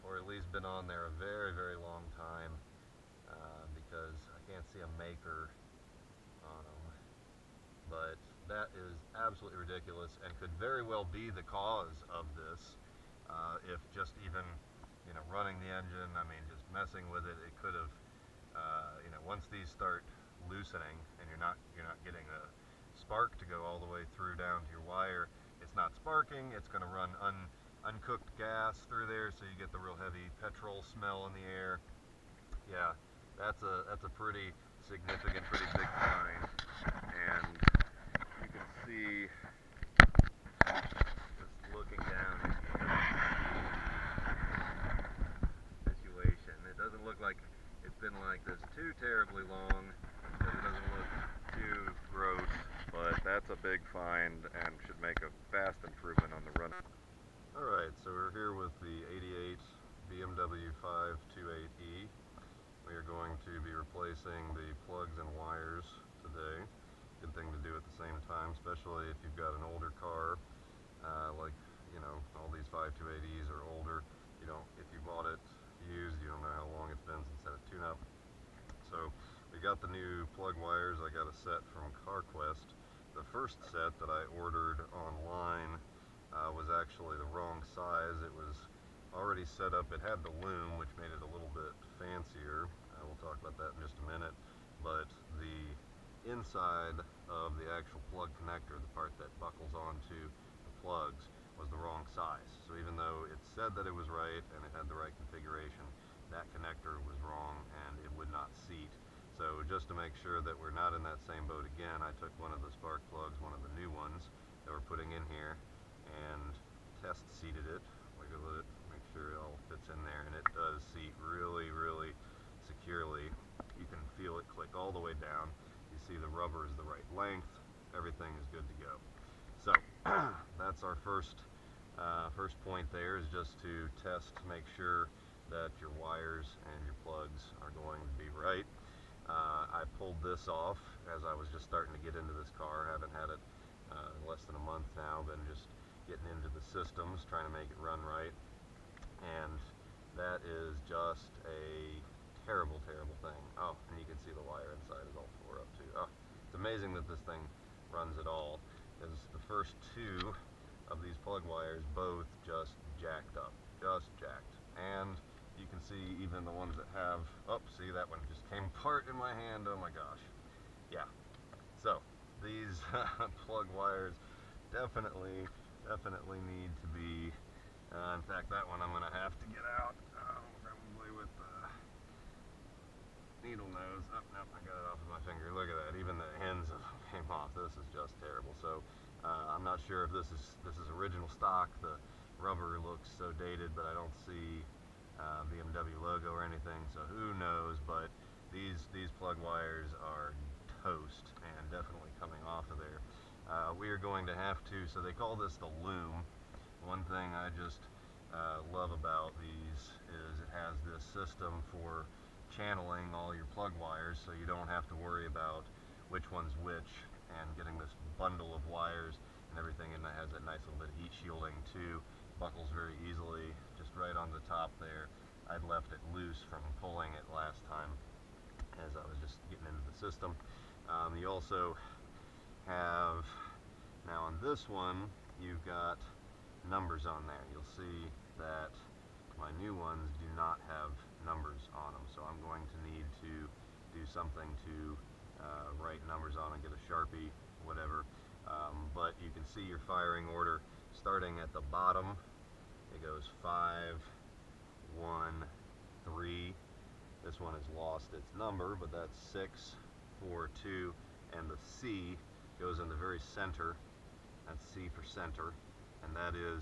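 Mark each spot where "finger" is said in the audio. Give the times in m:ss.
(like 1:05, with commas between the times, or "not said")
3:05.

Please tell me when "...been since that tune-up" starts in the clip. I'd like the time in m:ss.
1:17.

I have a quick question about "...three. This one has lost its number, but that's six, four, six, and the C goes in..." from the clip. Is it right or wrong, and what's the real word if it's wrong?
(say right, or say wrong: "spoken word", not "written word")
wrong: "two", not "six".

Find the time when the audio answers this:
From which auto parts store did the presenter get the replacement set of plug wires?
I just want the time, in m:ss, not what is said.
1:22.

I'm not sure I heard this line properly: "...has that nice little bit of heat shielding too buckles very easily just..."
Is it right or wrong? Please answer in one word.
right.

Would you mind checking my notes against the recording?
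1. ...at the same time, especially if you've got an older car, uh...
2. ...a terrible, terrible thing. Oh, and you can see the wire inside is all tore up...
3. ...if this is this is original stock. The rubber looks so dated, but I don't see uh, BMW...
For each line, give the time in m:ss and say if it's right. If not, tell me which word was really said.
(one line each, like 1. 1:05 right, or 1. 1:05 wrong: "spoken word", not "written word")
1. 1:07 right
2. 2:31 right
3. 3:10 right.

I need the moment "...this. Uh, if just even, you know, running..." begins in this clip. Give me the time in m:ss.
0:12.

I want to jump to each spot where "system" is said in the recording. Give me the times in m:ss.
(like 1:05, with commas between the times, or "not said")
2:26, 3:31, 3:49.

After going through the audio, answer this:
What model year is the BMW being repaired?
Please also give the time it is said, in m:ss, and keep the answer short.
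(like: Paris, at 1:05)
1988, at 0:59.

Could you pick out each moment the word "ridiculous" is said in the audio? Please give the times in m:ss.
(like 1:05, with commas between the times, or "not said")
0:09.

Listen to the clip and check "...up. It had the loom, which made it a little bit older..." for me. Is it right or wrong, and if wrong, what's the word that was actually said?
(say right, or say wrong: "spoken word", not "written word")
wrong: "fancier", not "older".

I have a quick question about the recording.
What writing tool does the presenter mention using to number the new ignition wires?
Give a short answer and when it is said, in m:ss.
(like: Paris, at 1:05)
A Sharpie, at 4:06.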